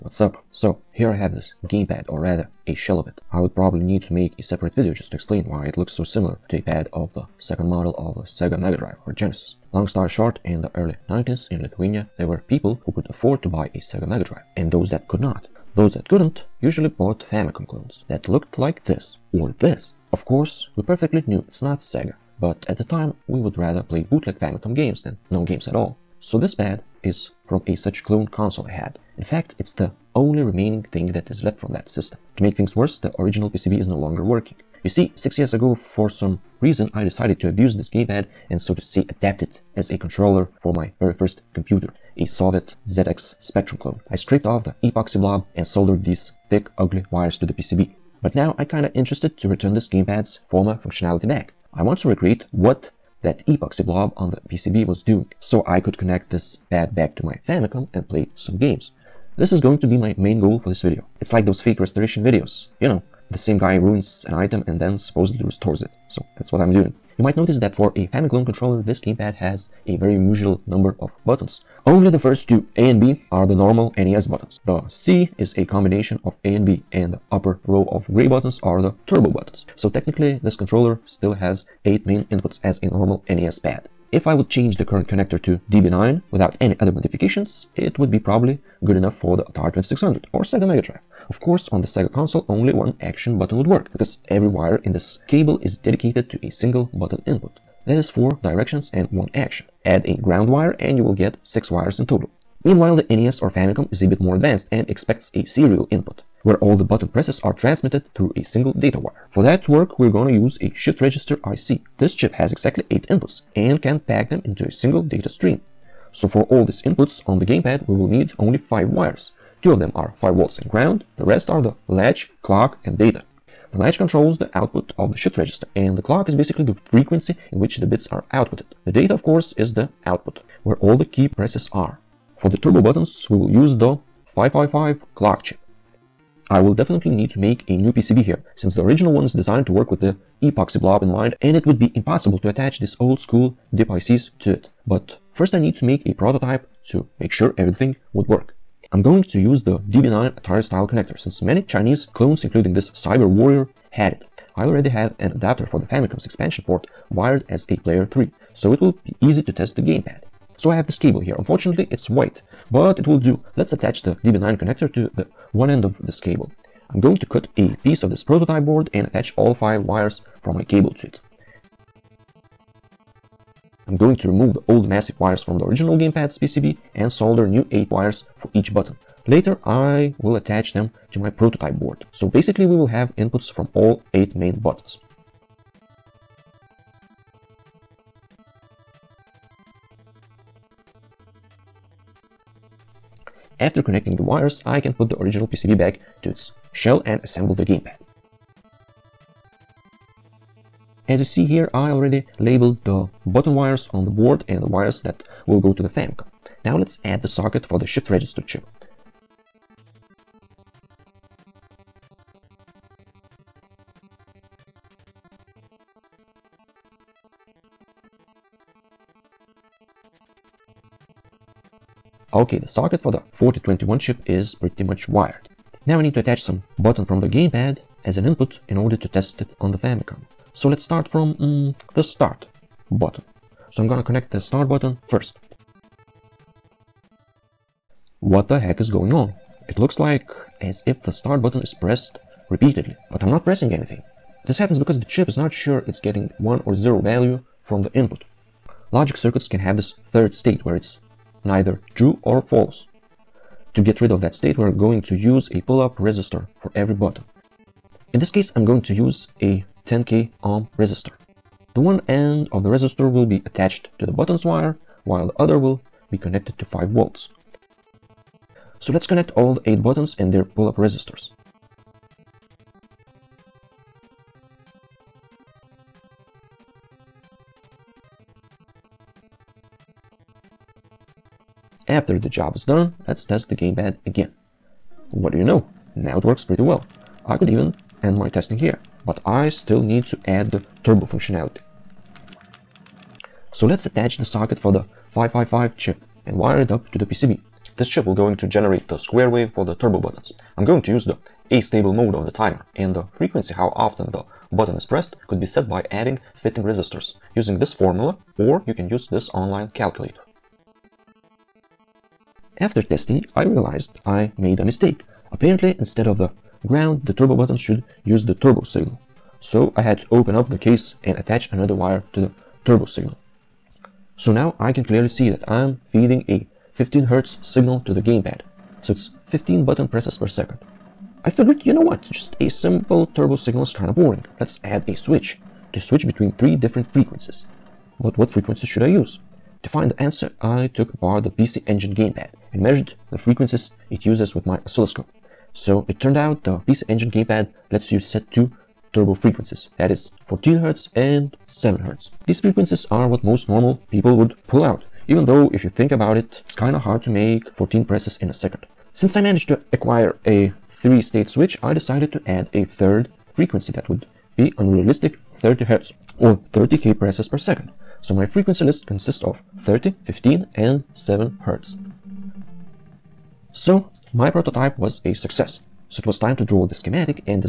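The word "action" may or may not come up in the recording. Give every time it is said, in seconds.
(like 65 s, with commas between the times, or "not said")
93 s, 99 s.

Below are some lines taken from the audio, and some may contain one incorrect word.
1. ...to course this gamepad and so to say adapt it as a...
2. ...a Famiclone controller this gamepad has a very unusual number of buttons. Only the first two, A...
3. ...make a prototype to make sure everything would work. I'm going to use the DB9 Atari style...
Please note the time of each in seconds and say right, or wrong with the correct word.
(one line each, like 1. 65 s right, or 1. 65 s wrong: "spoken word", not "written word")
1. 37 s wrong: "abuse", not "course"
2. 67 s right
3. 145 s right.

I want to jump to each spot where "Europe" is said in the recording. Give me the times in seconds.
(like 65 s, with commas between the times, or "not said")
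not said.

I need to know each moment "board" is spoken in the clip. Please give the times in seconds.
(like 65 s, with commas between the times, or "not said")
168 s, 181 s, 204 s.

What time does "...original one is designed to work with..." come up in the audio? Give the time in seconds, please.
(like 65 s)
138 s.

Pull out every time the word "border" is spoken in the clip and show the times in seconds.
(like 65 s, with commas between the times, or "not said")
not said.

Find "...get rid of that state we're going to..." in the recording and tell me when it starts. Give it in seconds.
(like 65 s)
253 s.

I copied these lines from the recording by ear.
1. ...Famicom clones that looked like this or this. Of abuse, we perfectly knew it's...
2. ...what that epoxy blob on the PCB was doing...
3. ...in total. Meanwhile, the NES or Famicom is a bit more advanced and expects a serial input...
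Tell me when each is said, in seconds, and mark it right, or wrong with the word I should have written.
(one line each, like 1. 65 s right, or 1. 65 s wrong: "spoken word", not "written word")
1. 17 s wrong: "course", not "abuse"
2. 52 s right
3. 101 s right.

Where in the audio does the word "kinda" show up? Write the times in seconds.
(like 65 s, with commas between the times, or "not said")
48 s, 333 s, 356 s.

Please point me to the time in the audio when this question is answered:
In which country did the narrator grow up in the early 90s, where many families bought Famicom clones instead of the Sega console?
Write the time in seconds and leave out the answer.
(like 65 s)
11 s.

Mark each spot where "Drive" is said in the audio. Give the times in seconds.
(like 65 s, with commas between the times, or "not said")
8 s, 14 s, 90 s.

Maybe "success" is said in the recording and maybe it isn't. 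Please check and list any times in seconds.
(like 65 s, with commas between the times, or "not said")
375 s.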